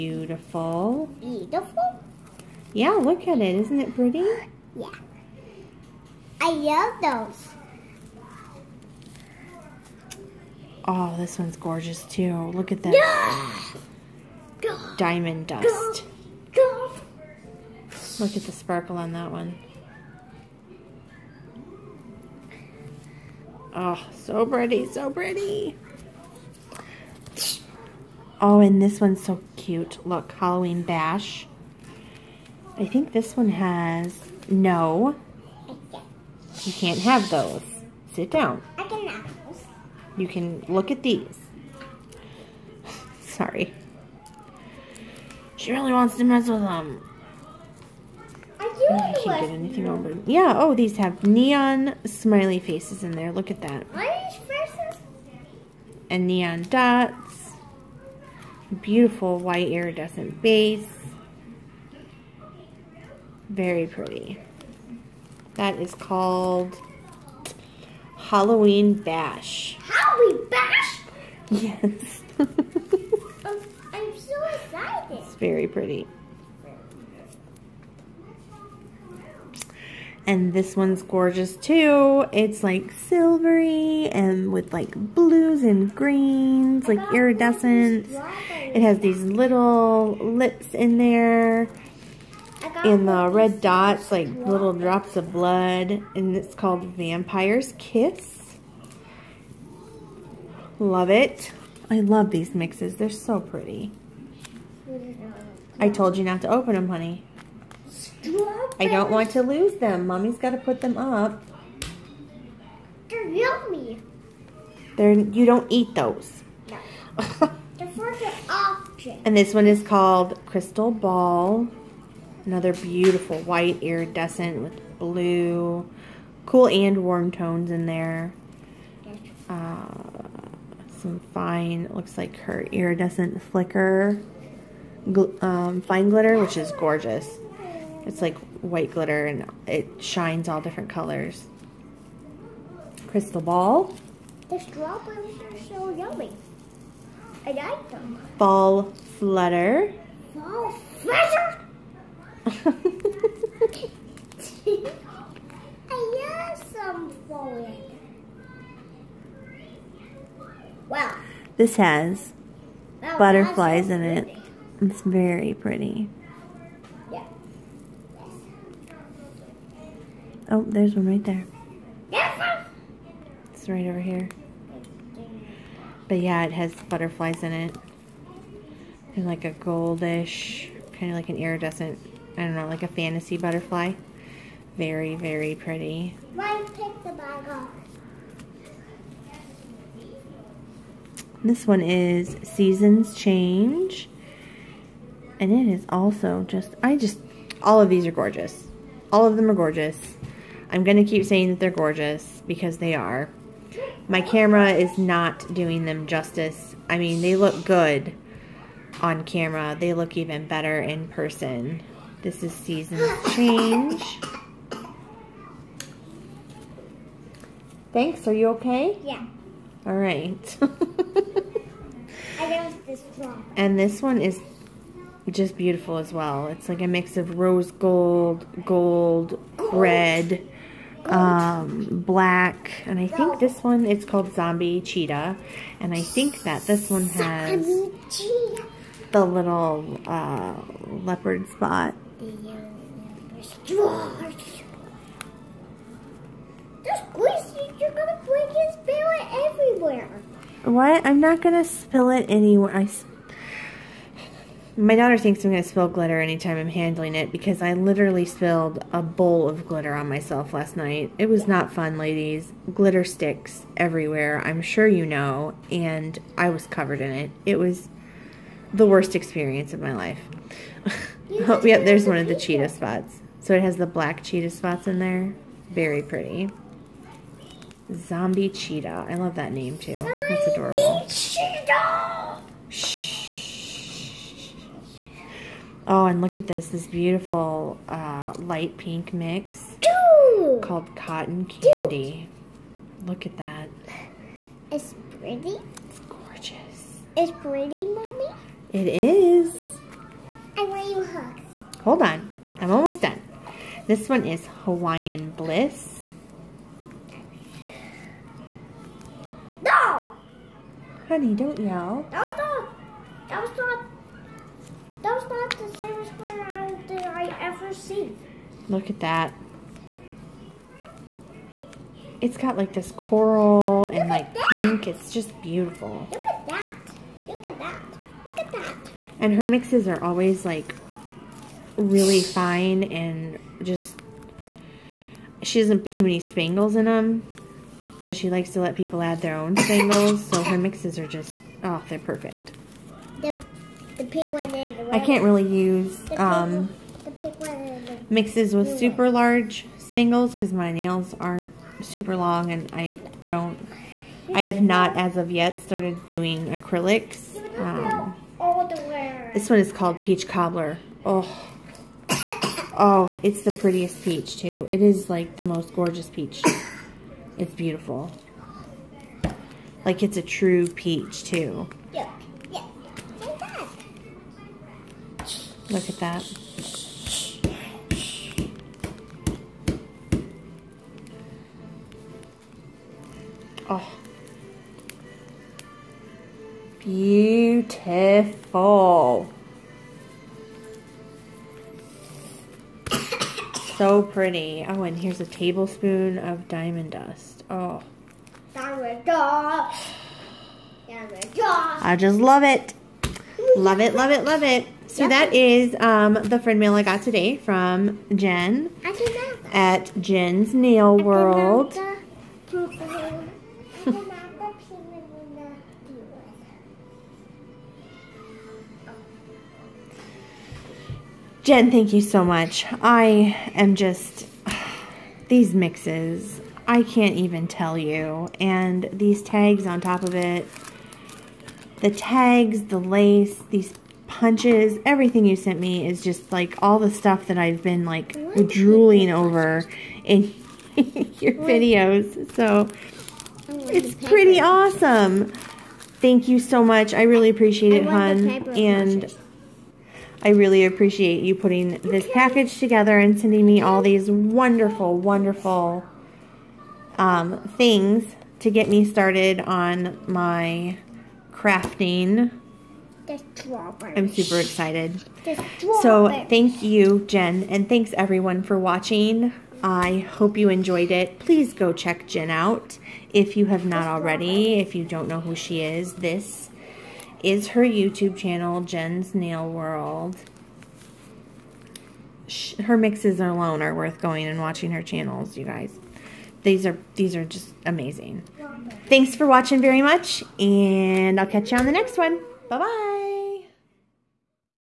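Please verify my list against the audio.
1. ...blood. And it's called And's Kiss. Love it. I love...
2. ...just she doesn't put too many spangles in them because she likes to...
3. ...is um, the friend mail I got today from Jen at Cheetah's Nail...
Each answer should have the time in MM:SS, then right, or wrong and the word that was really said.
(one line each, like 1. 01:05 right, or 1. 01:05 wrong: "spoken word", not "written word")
1. 01:35 wrong: "Vampire", not "And"
2. 05:33 right
3. 06:45 wrong: "Jen", not "Cheetah".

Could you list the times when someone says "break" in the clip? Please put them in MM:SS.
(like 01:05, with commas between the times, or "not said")
04:08.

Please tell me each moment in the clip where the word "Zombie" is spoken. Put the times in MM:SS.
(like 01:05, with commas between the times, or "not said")
03:54, 04:37.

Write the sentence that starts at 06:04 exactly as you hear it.
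It is like the most gorgeous peach.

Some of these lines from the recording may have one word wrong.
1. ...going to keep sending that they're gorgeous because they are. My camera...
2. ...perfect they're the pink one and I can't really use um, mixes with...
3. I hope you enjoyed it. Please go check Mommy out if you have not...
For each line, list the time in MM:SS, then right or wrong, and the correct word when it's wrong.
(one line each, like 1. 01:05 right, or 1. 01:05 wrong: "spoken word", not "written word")
1. 03:20 wrong: "saying", not "sending"
2. 05:41 right
3. 07:49 wrong: "Jen", not "Mommy".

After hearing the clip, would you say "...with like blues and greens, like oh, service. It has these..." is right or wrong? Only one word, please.
wrong.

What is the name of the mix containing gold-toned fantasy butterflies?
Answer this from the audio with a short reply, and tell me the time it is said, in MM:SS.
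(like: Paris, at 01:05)
Seasons Change, at 03:12.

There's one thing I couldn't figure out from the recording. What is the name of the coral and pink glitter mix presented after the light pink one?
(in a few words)
Hawaiian Bliss.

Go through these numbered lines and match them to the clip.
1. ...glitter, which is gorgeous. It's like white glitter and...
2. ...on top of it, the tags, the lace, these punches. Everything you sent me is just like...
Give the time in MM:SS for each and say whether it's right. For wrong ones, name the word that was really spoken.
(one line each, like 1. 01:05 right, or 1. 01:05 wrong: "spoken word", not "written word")
1. 02:16 right
2. 07:09 right.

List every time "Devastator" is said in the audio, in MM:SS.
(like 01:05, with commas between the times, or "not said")
not said.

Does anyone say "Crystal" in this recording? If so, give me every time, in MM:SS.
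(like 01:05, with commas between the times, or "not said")
02:00, 02:23.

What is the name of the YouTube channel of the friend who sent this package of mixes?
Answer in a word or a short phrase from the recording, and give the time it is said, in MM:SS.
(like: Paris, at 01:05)
Jen's Nail World, at 07:58.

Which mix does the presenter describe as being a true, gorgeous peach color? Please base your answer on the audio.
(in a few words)
Peach Cobbler.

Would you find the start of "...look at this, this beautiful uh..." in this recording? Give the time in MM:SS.
04:46.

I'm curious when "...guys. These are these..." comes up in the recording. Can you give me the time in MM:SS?
08:05.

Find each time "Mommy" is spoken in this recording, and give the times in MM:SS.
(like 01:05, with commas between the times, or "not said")
01:50, 04:57.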